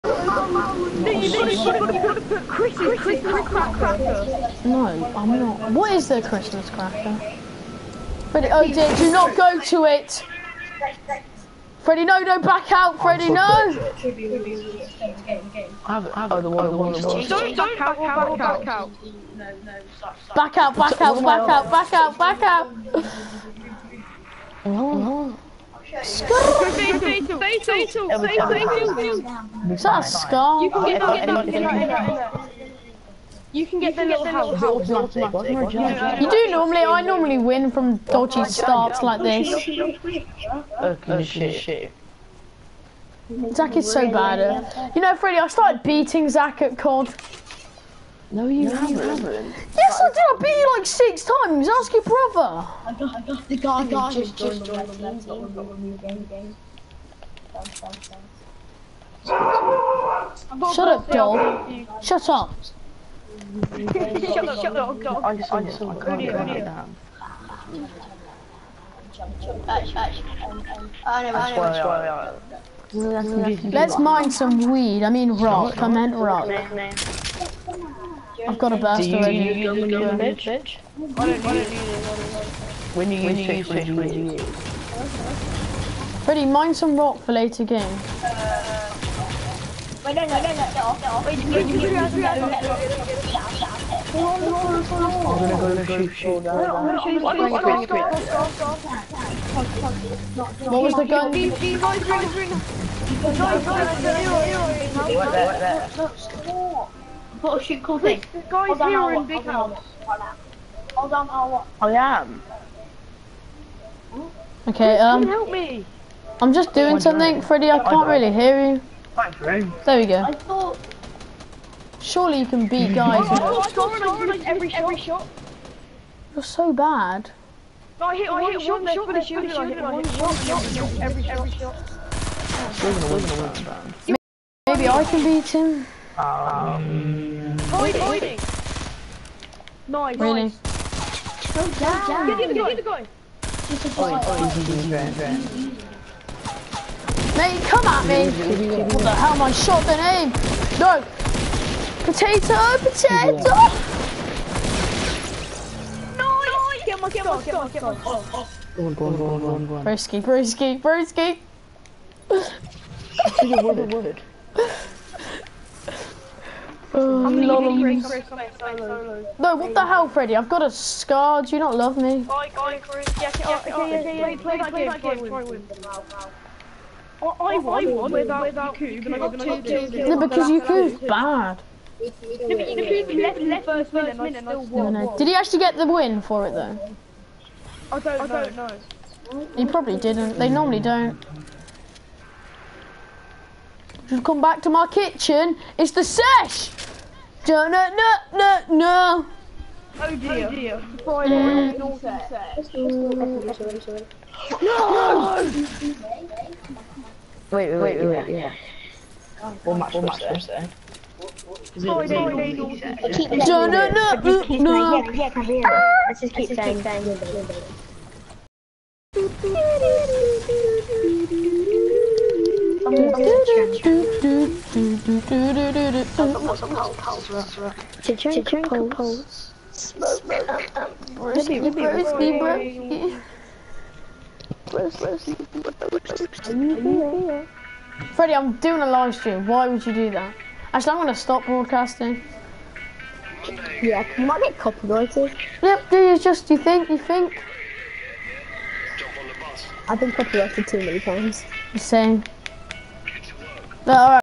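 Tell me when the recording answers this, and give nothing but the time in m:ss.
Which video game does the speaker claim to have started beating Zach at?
0:46.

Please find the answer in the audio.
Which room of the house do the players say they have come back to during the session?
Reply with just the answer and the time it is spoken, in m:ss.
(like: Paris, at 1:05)
kitchen, at 3:14.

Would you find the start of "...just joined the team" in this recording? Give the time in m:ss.
0:54.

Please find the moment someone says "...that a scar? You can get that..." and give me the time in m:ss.
0:29.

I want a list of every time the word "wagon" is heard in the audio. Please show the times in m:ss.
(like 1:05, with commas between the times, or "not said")
not said.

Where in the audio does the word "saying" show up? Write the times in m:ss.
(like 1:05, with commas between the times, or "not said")
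3:30, 3:36.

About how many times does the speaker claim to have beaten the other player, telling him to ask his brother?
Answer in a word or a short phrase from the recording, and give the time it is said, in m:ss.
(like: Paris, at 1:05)
6, at 0:50.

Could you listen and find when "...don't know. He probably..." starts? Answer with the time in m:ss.
3:07.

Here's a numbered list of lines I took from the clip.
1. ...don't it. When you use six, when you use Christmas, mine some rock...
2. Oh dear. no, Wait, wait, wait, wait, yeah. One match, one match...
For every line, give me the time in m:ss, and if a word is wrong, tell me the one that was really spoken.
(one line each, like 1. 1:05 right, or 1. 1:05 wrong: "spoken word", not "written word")
1. 1:20 wrong: "Ready", not "Christmas"
2. 3:21 right.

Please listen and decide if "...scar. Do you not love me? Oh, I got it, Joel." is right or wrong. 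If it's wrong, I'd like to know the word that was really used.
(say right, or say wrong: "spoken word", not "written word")
wrong: "Chris", not "Joel".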